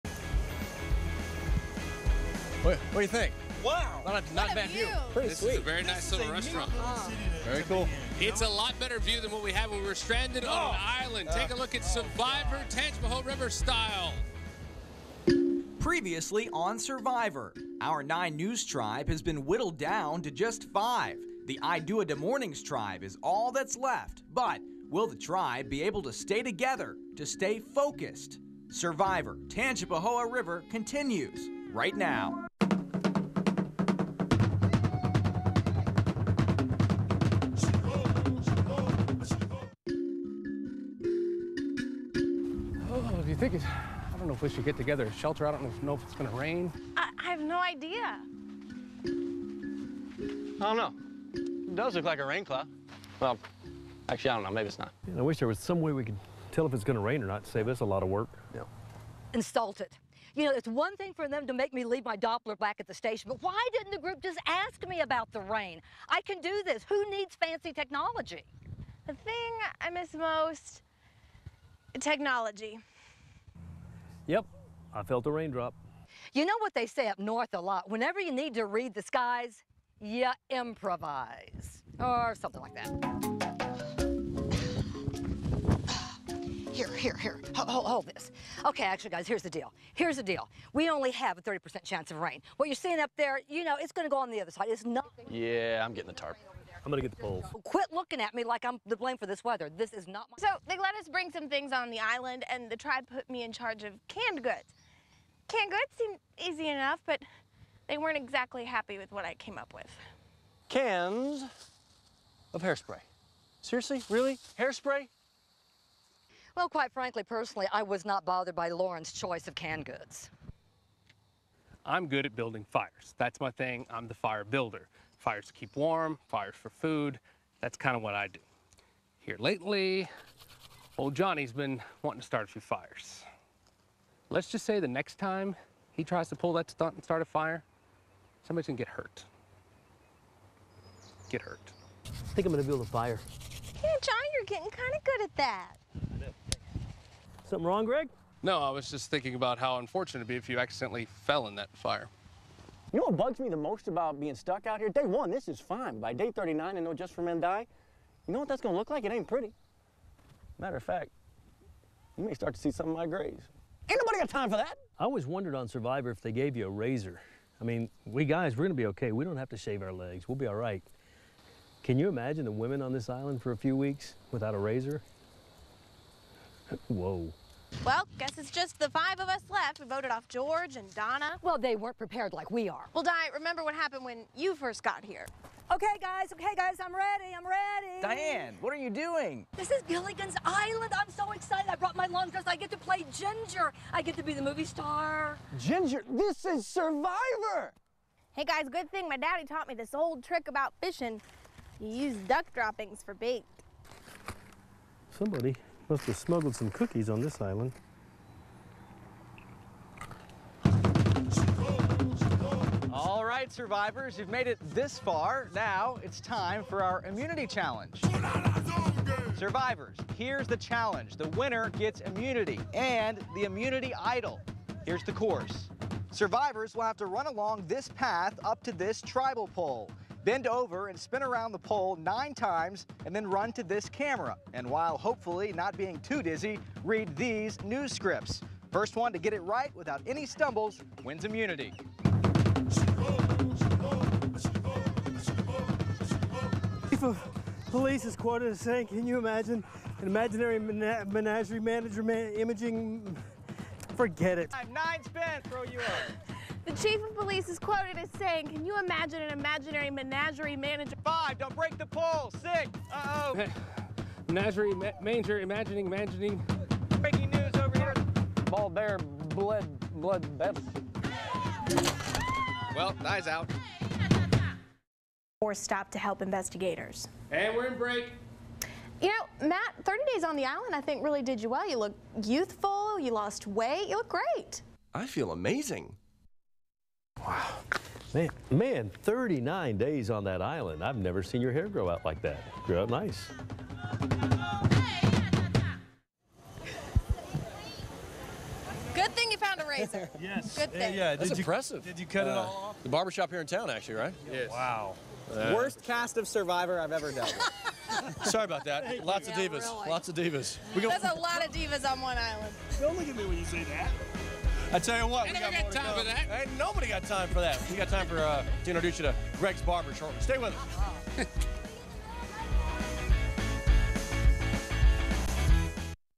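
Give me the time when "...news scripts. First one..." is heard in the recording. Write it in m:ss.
3:57.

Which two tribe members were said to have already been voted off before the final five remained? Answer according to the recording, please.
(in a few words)
George and Donna.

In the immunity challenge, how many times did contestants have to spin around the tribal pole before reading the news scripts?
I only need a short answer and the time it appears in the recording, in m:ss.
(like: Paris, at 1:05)
9, at 3:51.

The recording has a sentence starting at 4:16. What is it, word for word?
The chief of police is quoted as saying, can you imagine an imaginary menagerie manager?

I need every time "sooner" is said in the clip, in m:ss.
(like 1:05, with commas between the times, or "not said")
not said.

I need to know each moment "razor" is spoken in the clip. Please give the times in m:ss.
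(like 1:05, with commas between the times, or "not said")
2:46, 2:54, 4:59.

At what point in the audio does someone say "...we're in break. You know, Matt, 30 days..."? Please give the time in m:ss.
4:37.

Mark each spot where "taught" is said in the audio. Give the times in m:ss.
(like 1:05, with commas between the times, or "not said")
3:19.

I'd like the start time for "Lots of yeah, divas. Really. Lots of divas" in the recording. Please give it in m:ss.
5:09.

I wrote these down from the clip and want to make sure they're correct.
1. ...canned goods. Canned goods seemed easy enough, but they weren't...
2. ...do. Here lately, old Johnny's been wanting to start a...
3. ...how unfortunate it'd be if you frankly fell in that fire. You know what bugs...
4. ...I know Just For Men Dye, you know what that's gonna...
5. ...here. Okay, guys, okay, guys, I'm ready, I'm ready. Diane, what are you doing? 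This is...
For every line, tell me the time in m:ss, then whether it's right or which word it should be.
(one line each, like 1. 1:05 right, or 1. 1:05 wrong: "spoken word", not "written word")
1. 1:44 right
2. 2:08 right
3. 2:29 wrong: "accidentally", not "frankly"
4. 2:36 right
5. 3:05 right.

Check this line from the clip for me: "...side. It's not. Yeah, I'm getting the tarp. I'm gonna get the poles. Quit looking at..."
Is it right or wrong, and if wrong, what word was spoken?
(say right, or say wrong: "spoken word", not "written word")
right.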